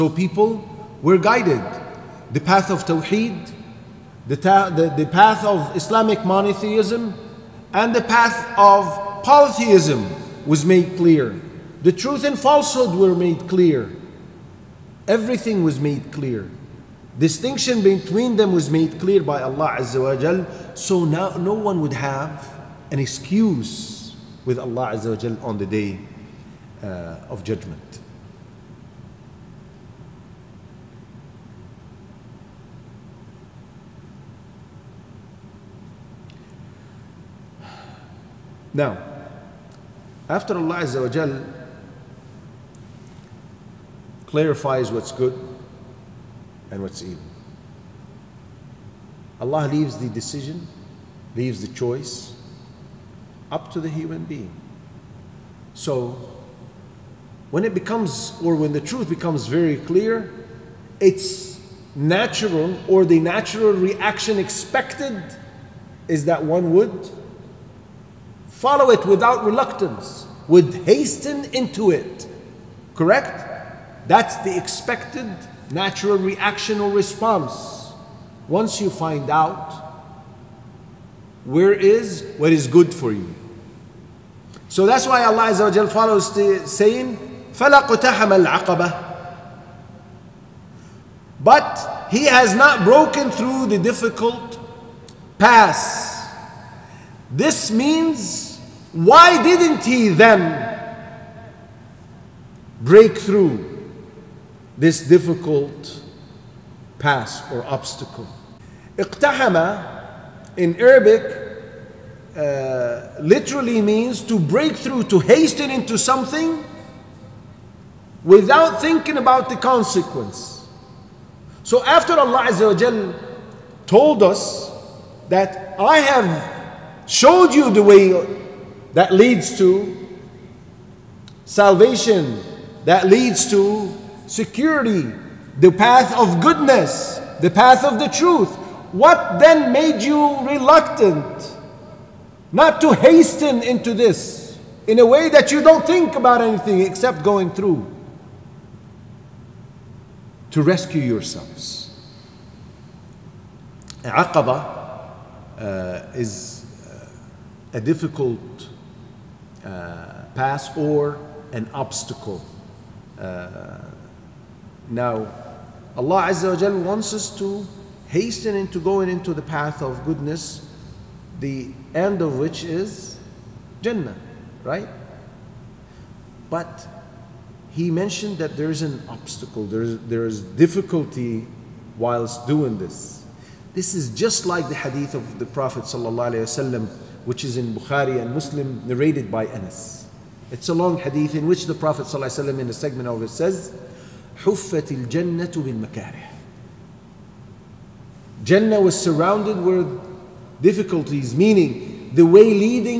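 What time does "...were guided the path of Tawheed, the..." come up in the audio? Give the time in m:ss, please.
0:01.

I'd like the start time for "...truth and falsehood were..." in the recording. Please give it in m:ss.
0:11.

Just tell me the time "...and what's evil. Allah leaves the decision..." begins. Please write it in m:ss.
0:46.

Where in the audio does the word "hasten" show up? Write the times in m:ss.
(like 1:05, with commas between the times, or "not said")
1:10, 1:55, 2:22, 2:48.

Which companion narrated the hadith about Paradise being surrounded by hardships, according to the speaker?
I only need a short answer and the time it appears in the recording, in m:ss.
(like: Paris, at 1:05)
Anas, at 3:09.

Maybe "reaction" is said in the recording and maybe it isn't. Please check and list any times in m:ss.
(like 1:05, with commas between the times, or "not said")
1:03, 1:16.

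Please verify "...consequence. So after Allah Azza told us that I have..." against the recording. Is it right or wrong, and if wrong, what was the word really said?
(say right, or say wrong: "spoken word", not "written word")
right.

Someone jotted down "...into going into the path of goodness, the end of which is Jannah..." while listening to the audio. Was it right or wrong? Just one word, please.
right.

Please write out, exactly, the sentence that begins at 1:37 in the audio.
This means, why didn't he then break through?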